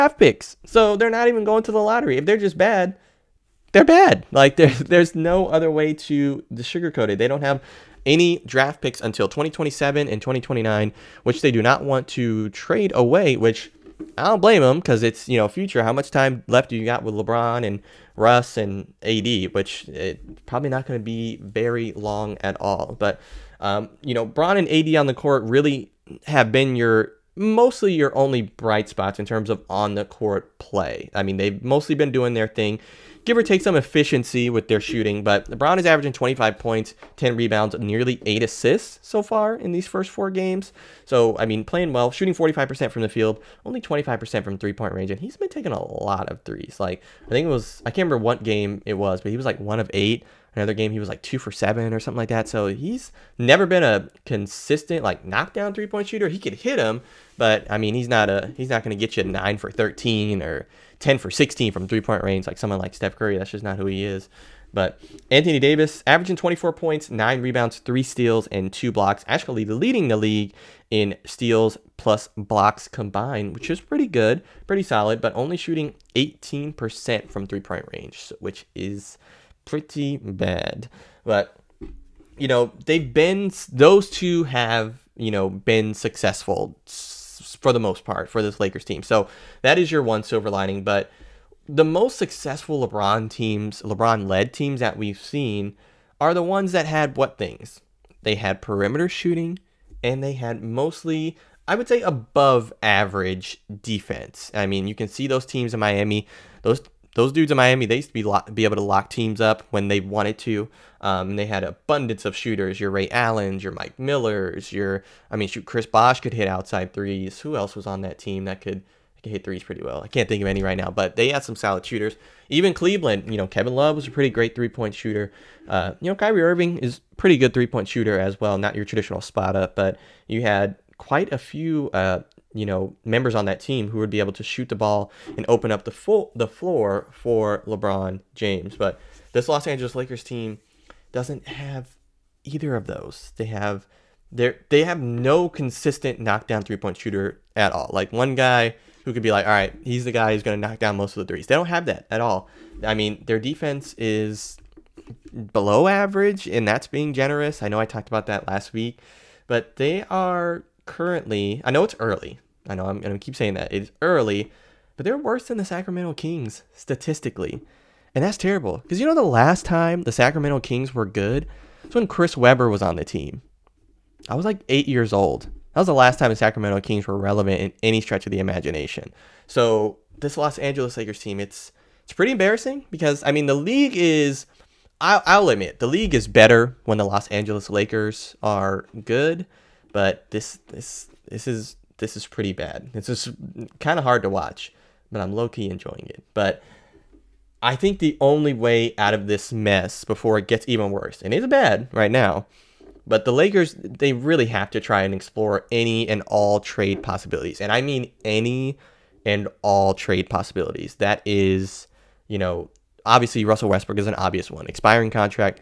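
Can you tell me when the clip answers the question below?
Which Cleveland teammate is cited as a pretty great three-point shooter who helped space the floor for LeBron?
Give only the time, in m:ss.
2:03.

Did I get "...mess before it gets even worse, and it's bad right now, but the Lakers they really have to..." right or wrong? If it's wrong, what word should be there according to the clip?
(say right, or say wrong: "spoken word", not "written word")
right.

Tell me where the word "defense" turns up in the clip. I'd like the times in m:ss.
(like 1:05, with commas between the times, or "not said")
1:43, 2:33.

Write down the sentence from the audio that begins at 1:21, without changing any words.
But you know, they've been those two have you know been successful for the most part for this Lakers team.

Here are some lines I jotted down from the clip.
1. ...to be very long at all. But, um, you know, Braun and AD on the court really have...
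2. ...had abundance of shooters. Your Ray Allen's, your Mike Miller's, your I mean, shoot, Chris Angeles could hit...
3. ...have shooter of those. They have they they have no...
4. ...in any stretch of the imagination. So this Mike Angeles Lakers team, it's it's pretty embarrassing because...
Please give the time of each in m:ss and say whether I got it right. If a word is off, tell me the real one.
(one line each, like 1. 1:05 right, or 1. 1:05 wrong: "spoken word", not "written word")
1. 0:20 right
2. 1:51 wrong: "Bosh", not "Angeles"
3. 2:21 wrong: "either", not "shooter"
4. 2:57 wrong: "Los", not "Mike".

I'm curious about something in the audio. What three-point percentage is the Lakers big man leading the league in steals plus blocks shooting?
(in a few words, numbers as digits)
18%.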